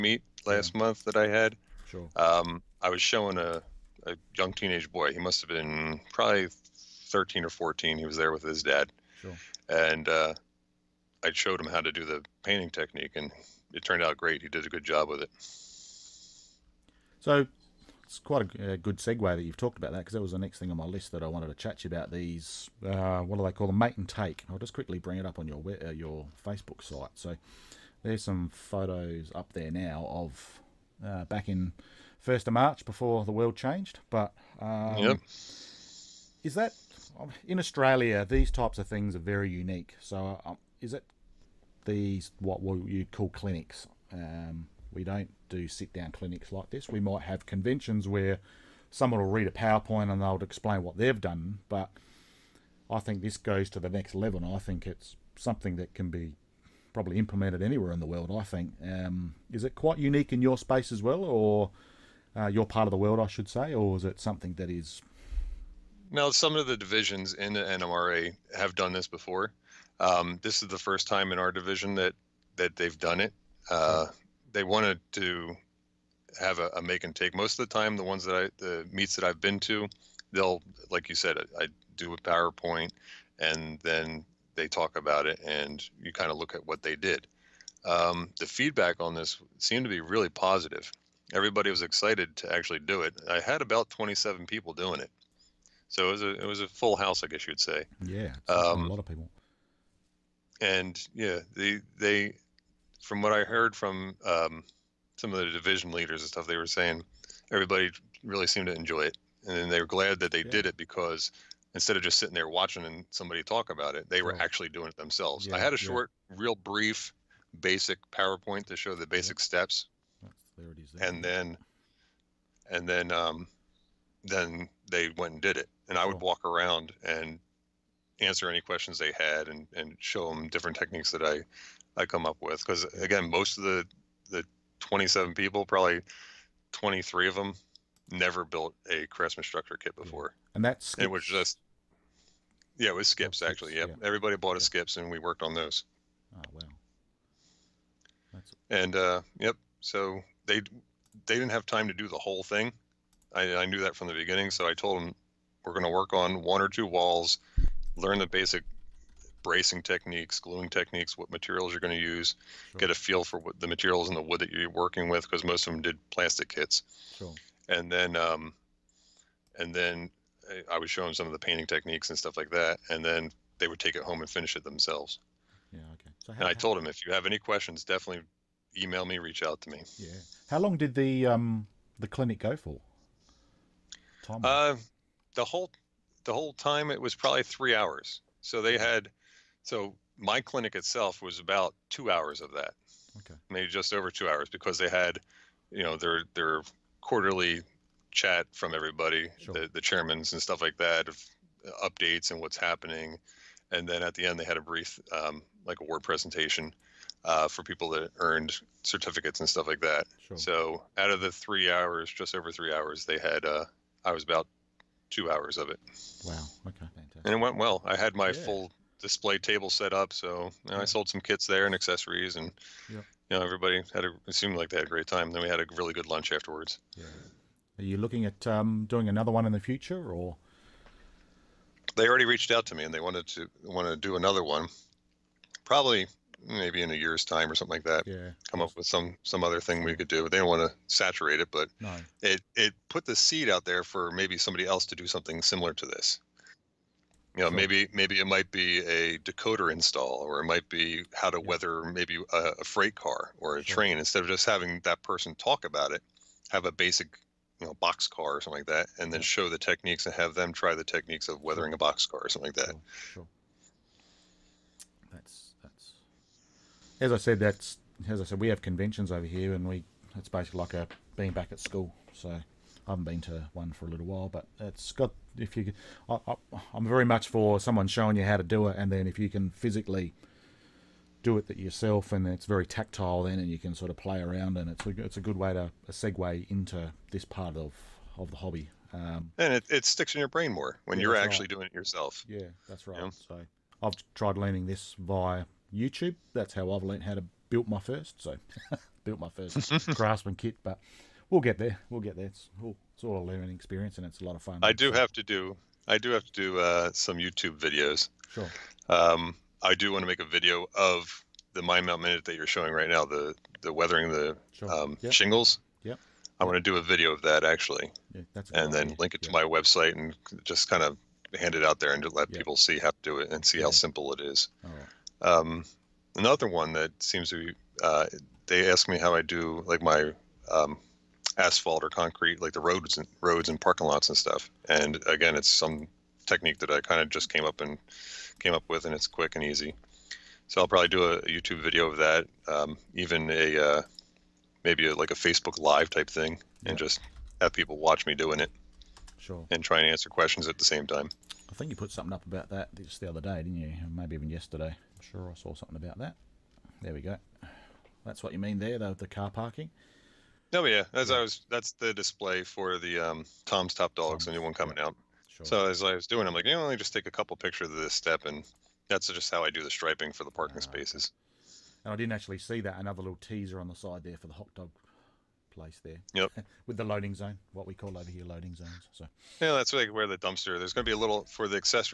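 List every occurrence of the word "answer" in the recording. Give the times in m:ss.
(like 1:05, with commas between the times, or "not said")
2:08, 5:49.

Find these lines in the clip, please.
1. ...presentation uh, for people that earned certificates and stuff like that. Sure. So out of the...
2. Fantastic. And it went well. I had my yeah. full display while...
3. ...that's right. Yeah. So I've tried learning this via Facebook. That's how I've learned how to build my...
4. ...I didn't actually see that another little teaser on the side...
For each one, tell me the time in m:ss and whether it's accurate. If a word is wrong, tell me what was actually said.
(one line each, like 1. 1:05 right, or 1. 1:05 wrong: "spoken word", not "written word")
1. 3:26 right
2. 3:36 wrong: "table", not "while"
3. 4:52 wrong: "YouTube", not "Facebook"
4. 6:11 right.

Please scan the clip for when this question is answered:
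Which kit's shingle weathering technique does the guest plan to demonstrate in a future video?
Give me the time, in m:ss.
5:11.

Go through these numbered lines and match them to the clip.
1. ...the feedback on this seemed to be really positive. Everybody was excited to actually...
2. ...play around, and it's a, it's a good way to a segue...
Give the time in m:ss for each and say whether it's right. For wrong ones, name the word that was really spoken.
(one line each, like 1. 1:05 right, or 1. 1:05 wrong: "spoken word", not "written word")
1. 1:28 right
2. 4:43 right.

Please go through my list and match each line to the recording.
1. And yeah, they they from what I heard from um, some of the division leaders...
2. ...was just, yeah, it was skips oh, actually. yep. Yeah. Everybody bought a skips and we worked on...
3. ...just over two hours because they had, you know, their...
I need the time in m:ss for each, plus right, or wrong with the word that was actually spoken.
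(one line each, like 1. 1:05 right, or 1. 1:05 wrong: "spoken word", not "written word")
1. 1:40 right
2. 2:21 right
3. 3:13 right.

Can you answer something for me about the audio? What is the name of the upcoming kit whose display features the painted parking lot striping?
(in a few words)
Tom's Top Dogs.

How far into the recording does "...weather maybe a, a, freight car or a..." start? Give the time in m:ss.
4:11.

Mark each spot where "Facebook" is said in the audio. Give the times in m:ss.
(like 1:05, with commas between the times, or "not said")
0:26, 5:45.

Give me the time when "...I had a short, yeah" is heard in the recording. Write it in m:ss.
1:55.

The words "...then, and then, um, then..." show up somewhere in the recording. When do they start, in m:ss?
2:01.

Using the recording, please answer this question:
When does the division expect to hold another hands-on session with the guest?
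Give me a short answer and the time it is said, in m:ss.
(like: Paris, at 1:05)
in a year's time, at 3:56.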